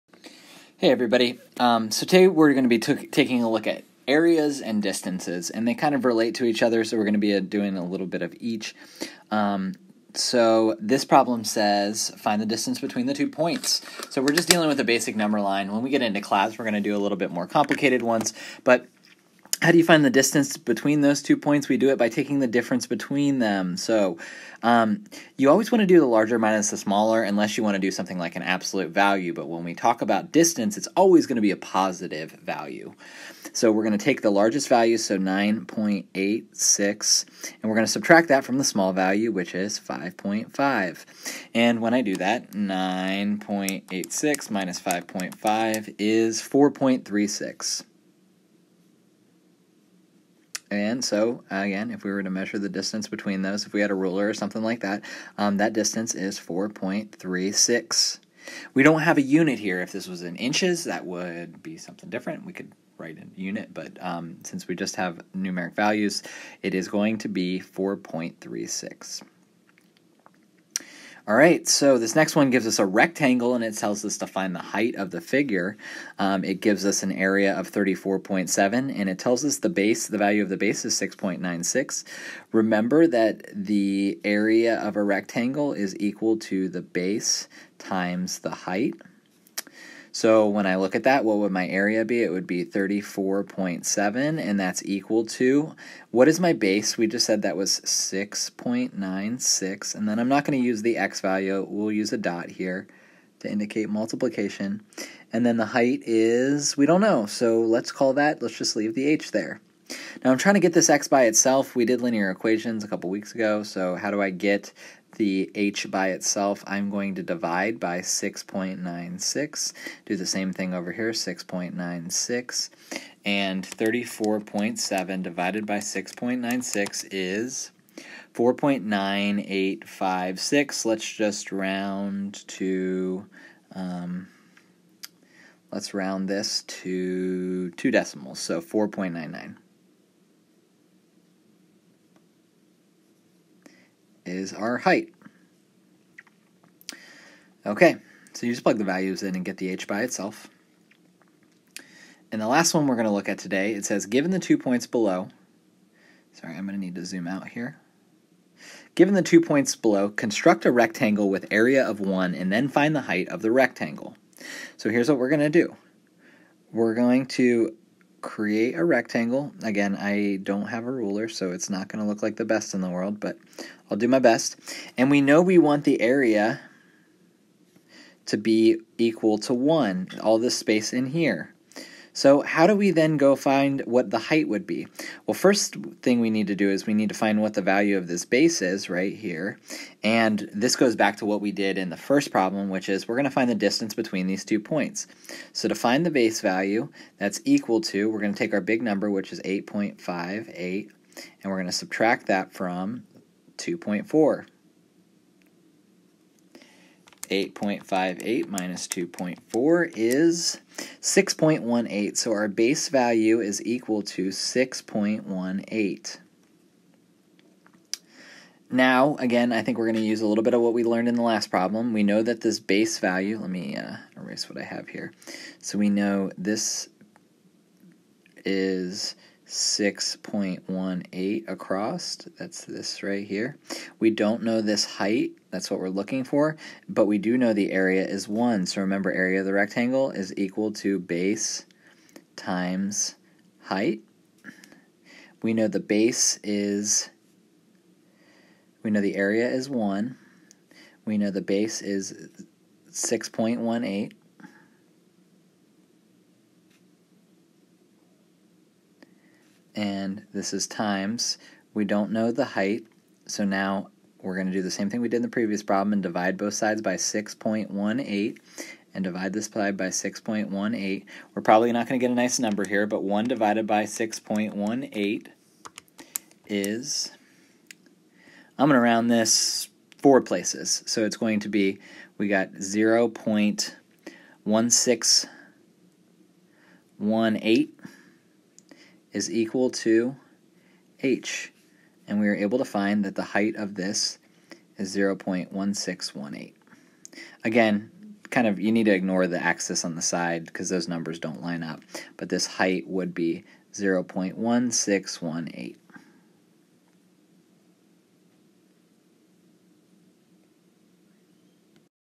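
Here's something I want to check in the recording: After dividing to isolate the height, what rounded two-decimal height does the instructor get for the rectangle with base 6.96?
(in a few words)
4.99.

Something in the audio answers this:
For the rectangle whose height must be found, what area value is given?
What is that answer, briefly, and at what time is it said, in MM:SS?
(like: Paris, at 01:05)
34.7, at 01:17.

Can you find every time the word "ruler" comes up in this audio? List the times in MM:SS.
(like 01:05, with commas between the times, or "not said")
00:53, 02:50.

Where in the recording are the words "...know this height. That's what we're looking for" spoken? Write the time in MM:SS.
03:54.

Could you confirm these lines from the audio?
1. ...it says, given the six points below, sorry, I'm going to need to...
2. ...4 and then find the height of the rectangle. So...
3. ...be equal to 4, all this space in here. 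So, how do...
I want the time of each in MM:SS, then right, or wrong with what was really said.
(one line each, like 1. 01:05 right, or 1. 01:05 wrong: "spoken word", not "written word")
1. 02:33 wrong: "two", not "six"
2. 02:41 wrong: "1", not "4"
3. 02:58 wrong: "1", not "4".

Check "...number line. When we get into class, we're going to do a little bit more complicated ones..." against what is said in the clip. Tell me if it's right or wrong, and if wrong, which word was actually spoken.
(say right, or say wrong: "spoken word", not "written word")
right.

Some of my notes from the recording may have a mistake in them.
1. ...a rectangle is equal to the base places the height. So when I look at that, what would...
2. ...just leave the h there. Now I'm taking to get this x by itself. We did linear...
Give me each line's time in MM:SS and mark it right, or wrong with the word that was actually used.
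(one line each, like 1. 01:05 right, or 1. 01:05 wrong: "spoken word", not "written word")
1. 01:24 wrong: "times", not "places"
2. 01:48 wrong: "trying", not "taking".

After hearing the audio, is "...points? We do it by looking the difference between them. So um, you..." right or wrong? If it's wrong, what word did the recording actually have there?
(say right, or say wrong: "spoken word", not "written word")
wrong: "taking", not "looking".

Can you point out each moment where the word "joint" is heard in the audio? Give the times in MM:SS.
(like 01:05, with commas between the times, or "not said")
not said.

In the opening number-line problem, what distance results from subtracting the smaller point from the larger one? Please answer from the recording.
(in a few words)
4.36.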